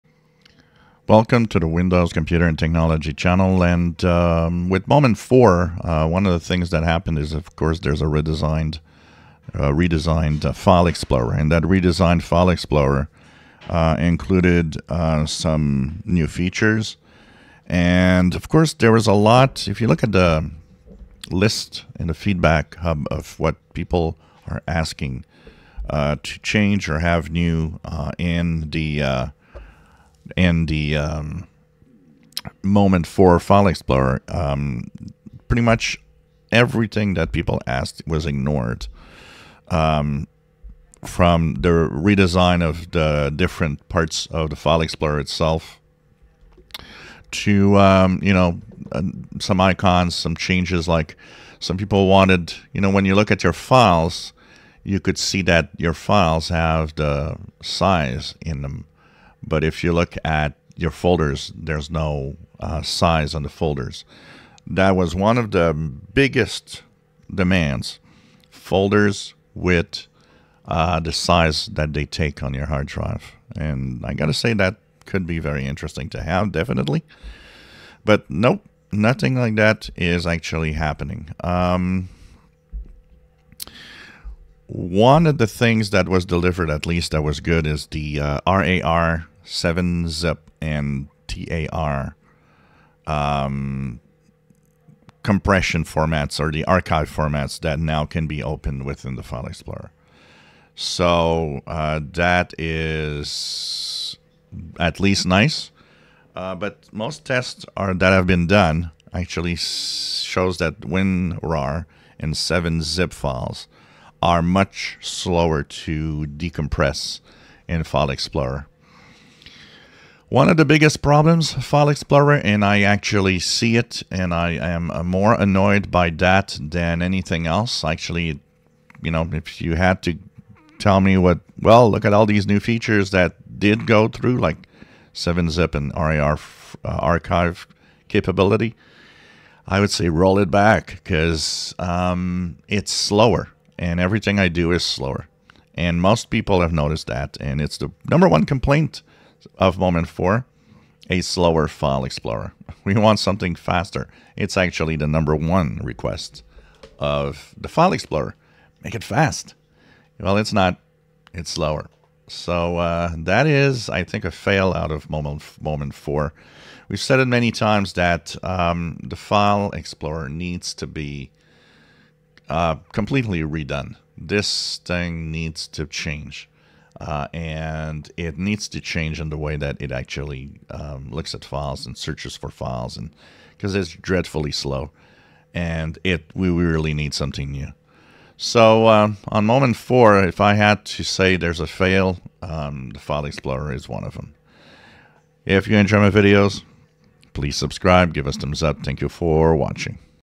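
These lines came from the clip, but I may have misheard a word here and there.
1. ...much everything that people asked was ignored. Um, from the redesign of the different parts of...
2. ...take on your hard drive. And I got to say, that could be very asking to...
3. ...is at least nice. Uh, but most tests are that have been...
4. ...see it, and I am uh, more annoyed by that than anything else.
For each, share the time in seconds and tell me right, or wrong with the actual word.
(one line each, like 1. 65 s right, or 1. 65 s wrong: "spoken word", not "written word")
1. 35 s right
2. 72 s wrong: "interesting", not "asking"
3. 102 s right
4. 123 s right.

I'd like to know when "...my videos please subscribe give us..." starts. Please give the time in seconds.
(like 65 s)
195 s.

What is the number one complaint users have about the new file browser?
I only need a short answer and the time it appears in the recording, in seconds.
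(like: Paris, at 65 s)
a slower file explorer, at 151 s.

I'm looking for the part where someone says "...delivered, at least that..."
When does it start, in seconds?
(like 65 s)
86 s.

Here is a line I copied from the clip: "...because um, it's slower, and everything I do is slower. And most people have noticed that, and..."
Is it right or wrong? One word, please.
right.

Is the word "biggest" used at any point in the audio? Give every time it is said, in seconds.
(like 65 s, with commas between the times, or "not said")
66 s, 120 s.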